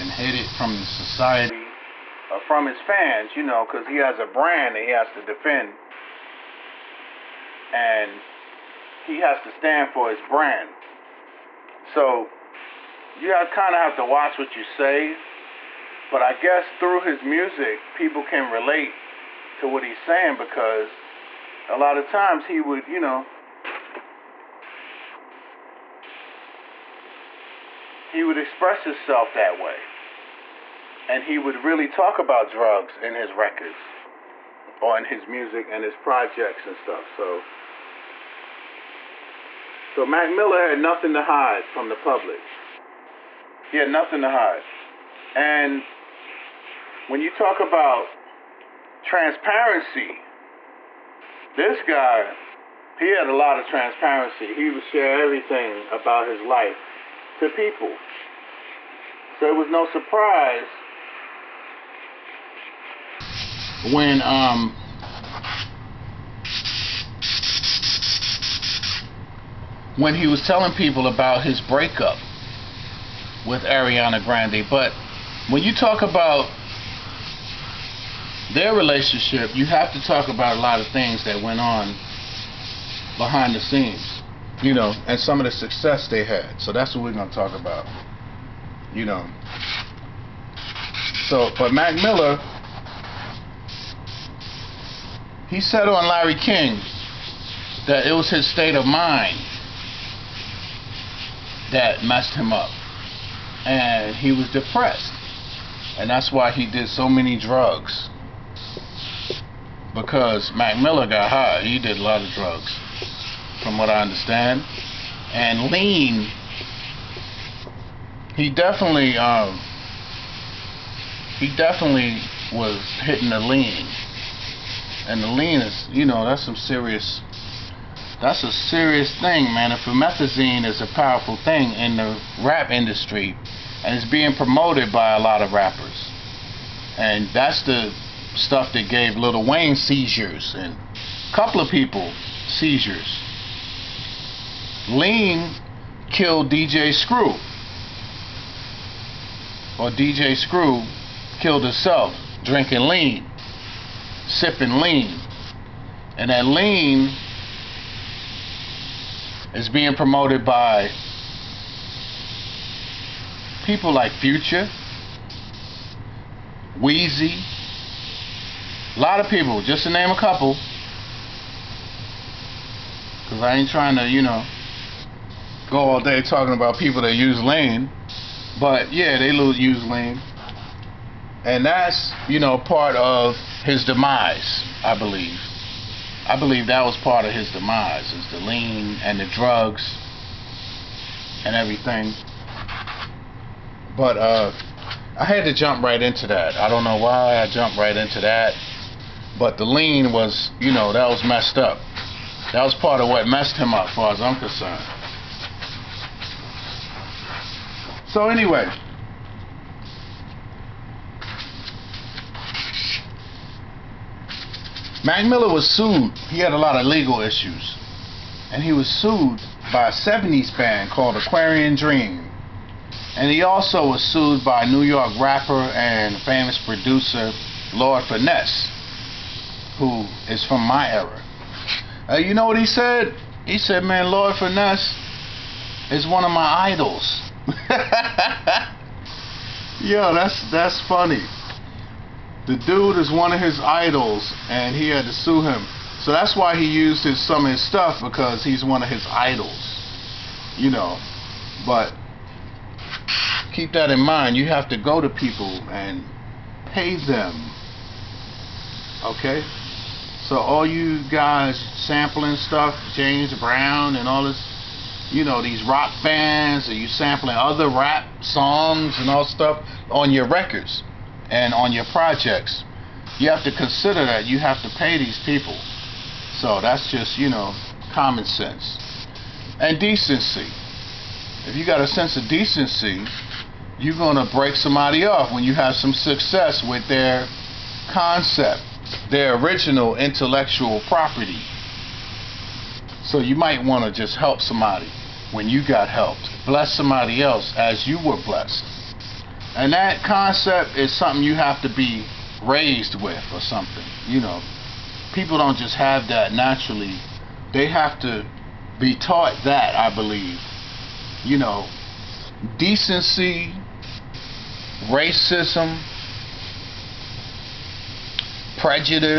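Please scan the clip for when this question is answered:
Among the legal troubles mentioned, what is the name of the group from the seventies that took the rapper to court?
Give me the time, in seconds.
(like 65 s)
221 s.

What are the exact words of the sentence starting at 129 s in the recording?
If promethazine is a powerful thing in the rap industry, and it's being promoted by a lot of rappers.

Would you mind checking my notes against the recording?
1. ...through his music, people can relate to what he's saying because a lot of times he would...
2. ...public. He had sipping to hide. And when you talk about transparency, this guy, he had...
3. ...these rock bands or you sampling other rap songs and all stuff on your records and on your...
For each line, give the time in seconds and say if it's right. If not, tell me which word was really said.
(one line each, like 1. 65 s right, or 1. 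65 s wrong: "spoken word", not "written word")
1. 16 s right
2. 42 s wrong: "nothing", not "sipping"
3. 265 s right.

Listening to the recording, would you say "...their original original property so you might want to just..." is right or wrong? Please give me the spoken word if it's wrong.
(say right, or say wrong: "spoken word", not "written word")
wrong: "intellectual", not "original".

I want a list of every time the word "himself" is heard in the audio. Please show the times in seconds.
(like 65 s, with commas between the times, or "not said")
28 s, 151 s.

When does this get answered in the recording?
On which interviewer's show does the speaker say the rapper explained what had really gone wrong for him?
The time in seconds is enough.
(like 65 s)
96 s.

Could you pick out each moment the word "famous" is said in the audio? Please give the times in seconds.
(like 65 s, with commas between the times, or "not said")
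226 s.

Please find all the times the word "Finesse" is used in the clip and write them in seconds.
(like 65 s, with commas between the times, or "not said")
228 s, 234 s.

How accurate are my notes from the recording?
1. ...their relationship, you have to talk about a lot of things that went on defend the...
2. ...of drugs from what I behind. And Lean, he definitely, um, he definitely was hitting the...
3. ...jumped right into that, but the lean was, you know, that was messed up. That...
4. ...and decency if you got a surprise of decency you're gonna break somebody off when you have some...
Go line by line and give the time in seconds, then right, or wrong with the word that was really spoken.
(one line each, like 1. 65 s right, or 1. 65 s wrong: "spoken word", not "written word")
1. 78 s wrong: "behind", not "defend"
2. 112 s wrong: "understand", not "behind"
3. 197 s right
4. 279 s wrong: "sense", not "surprise".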